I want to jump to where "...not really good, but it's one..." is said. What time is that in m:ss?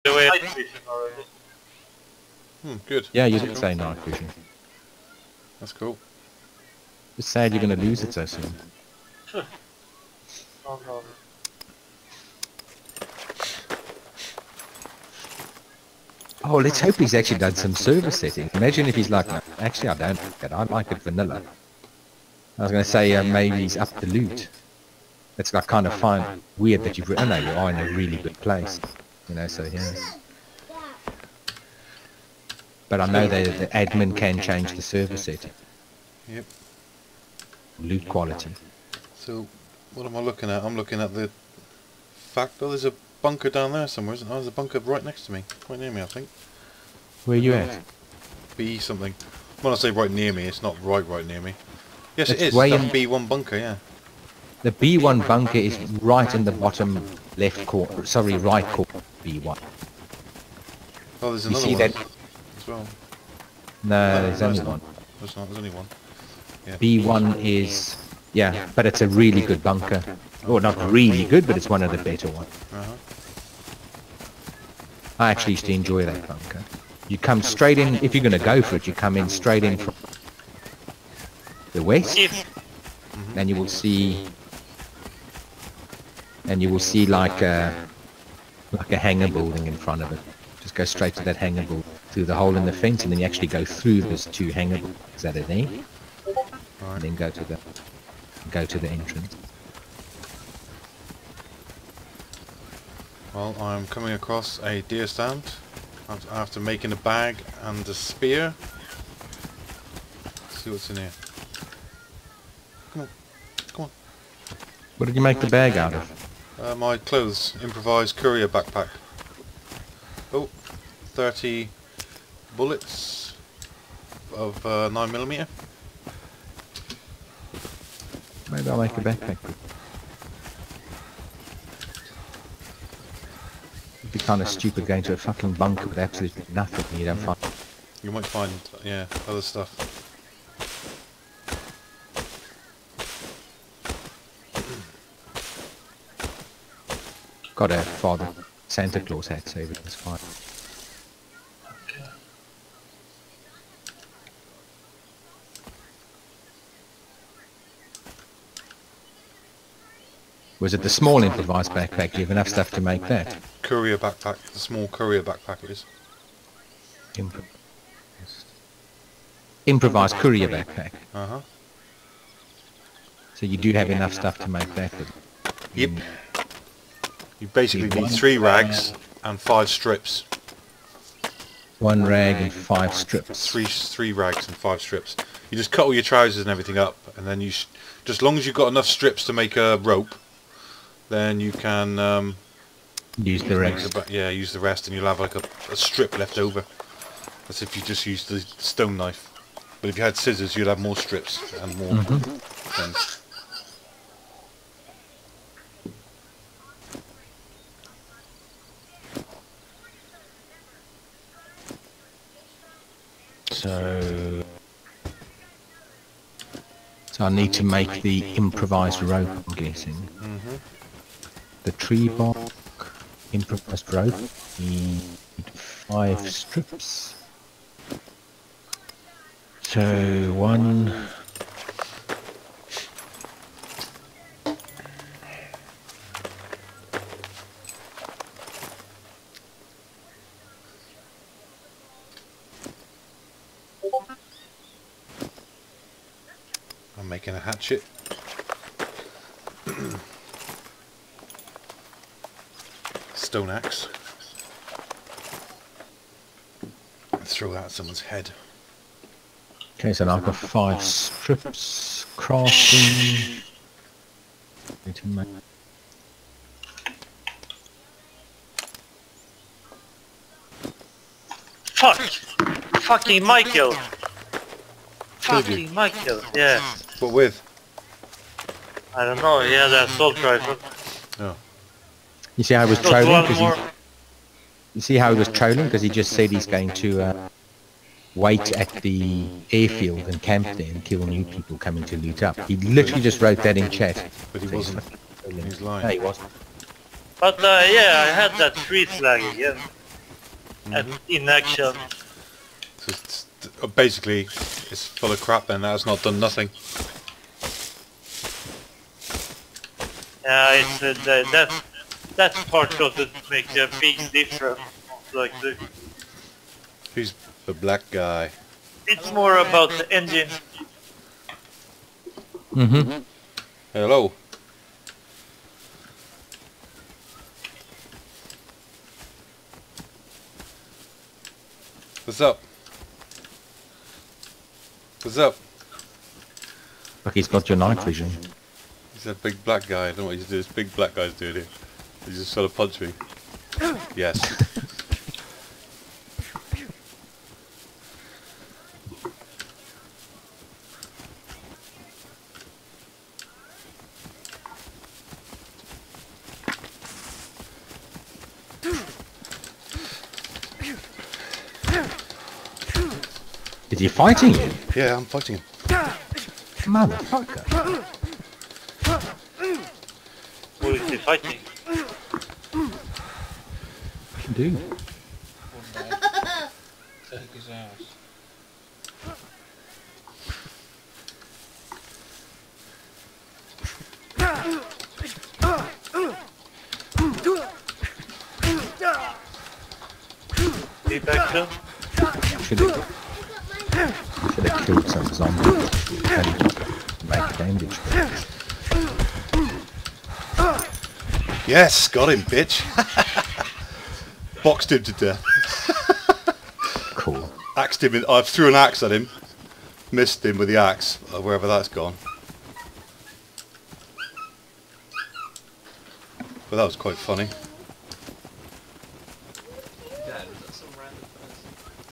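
1:10.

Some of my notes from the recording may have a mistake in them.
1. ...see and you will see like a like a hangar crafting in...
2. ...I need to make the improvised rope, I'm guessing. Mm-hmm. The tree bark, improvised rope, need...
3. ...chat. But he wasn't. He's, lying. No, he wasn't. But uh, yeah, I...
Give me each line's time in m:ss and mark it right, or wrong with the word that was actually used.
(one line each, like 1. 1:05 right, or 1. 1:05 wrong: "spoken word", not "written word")
1. 1:23 wrong: "building", not "crafting"
2. 3:37 right
3. 4:53 right.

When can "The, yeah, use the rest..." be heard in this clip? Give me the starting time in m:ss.
3:13.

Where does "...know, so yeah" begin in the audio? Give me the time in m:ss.
0:29.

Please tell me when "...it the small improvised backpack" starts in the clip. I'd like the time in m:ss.
2:40.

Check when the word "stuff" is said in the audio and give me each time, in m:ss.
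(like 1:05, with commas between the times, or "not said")
2:19, 2:42, 2:54.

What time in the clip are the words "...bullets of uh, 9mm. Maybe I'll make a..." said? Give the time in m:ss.
2:02.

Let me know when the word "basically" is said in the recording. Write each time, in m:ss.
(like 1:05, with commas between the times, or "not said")
2:57, 5:03.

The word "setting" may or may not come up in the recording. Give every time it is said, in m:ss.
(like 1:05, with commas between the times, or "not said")
0:18, 0:35.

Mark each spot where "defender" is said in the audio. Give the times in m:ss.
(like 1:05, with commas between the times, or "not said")
not said.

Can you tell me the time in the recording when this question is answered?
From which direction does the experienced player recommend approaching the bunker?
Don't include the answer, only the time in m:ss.
1:19.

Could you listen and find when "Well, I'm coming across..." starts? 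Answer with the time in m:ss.
1:43.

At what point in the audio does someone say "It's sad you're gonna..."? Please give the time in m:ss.
0:07.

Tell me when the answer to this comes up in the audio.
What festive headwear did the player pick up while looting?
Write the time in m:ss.
2:28.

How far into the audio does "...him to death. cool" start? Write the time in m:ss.
6:44.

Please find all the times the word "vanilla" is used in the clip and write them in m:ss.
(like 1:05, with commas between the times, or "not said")
0:21.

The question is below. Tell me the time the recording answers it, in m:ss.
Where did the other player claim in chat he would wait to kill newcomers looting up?
4:49.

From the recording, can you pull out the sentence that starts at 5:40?
This big black guy's doing here.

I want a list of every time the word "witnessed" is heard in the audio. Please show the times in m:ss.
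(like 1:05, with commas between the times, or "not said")
not said.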